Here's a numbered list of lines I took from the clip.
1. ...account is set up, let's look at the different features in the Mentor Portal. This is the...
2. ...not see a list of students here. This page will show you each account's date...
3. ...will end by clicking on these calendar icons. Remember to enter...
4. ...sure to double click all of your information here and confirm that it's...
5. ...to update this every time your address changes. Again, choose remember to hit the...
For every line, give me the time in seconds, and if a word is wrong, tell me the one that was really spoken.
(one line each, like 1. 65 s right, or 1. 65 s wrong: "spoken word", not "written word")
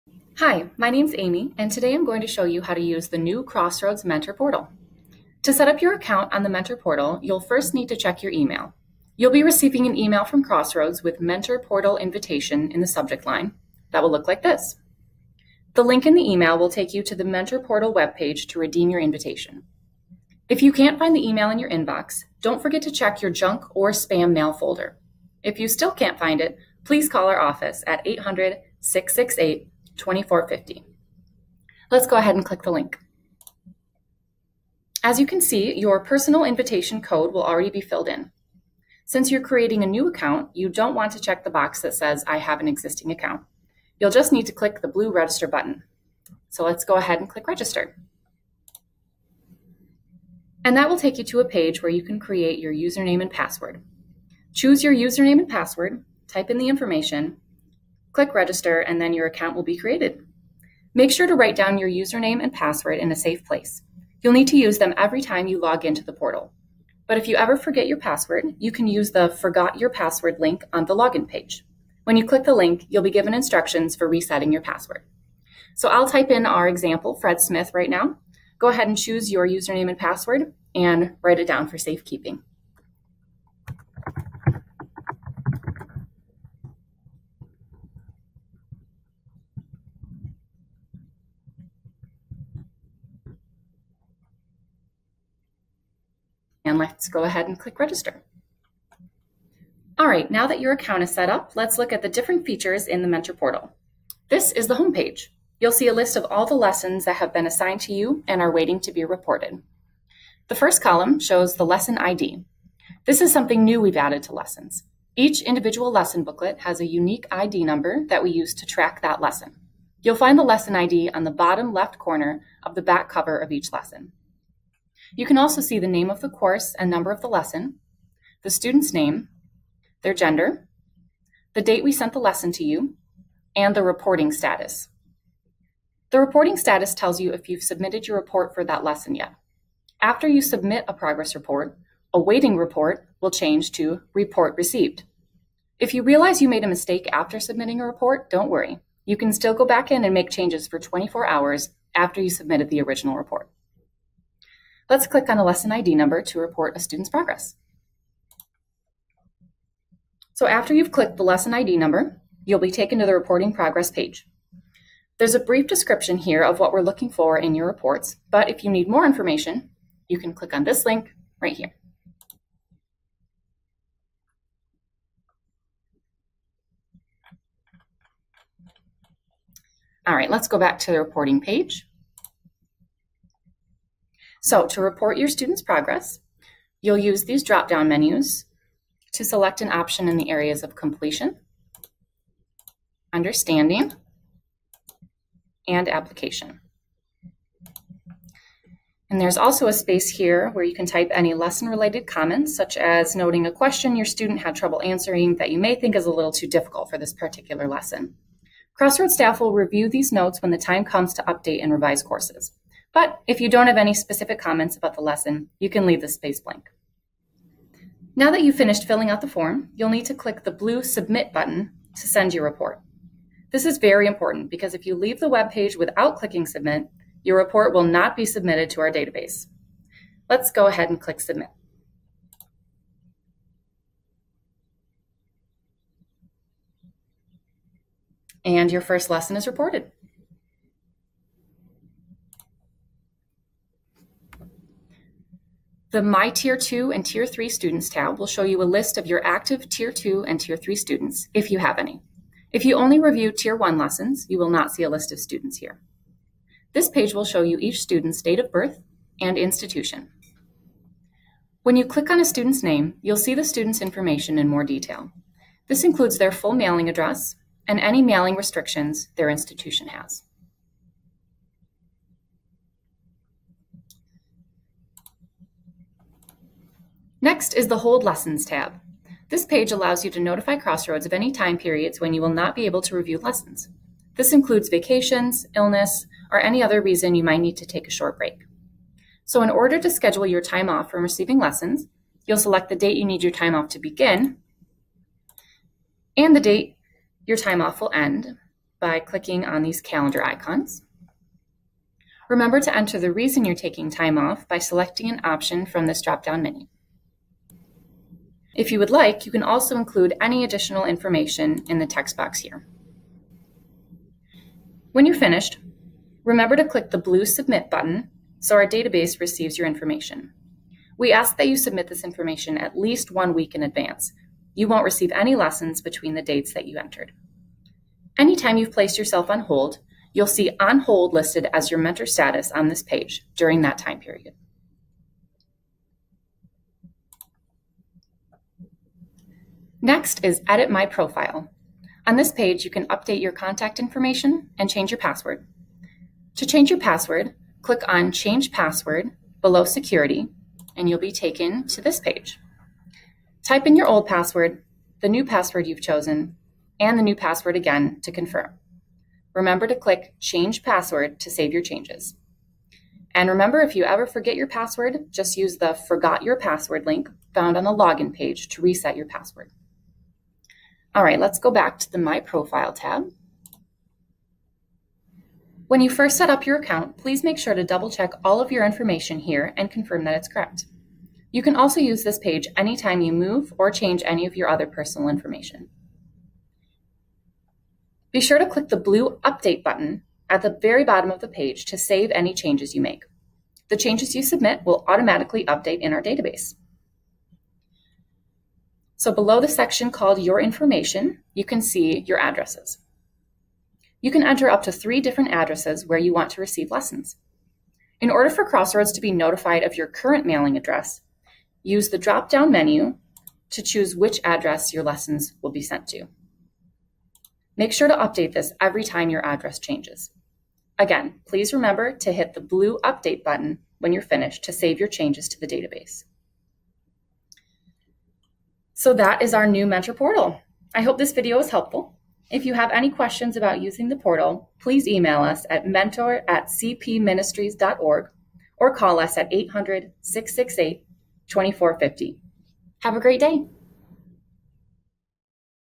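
1. 100 s right
2. 254 s wrong: "student", not "account"
3. 297 s right
4. 377 s wrong: "check", not "click"
5. 417 s wrong: "please", not "choose".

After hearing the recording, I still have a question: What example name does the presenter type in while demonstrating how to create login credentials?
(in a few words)
Fred Smith.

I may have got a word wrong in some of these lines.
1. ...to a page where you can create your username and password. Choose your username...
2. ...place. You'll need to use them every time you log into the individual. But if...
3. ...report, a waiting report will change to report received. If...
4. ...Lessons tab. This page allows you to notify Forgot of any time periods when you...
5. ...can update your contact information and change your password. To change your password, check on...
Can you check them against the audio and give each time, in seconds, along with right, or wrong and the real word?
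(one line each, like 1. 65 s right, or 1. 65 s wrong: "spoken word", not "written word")
1. 51 s right
2. 63 s wrong: "portal", not "individual"
3. 141 s right
4. 278 s wrong: "Crossroads", not "Forgot"
5. 342 s wrong: "click", not "check".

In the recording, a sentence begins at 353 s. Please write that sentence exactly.
Type in your old password, the new password you've chosen, and the new password again to confirm.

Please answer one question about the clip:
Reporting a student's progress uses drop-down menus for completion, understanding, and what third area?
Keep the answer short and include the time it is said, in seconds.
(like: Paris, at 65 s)
Application, at 195 s.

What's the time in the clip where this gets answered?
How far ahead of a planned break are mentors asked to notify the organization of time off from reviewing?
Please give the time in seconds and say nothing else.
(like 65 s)
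323 s.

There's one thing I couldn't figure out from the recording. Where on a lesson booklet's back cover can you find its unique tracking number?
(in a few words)
Bottom left corner.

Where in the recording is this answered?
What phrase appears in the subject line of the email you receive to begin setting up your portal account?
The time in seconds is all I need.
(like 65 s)
11 s.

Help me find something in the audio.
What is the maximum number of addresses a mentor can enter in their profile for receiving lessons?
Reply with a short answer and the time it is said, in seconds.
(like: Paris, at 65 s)
3, at 404 s.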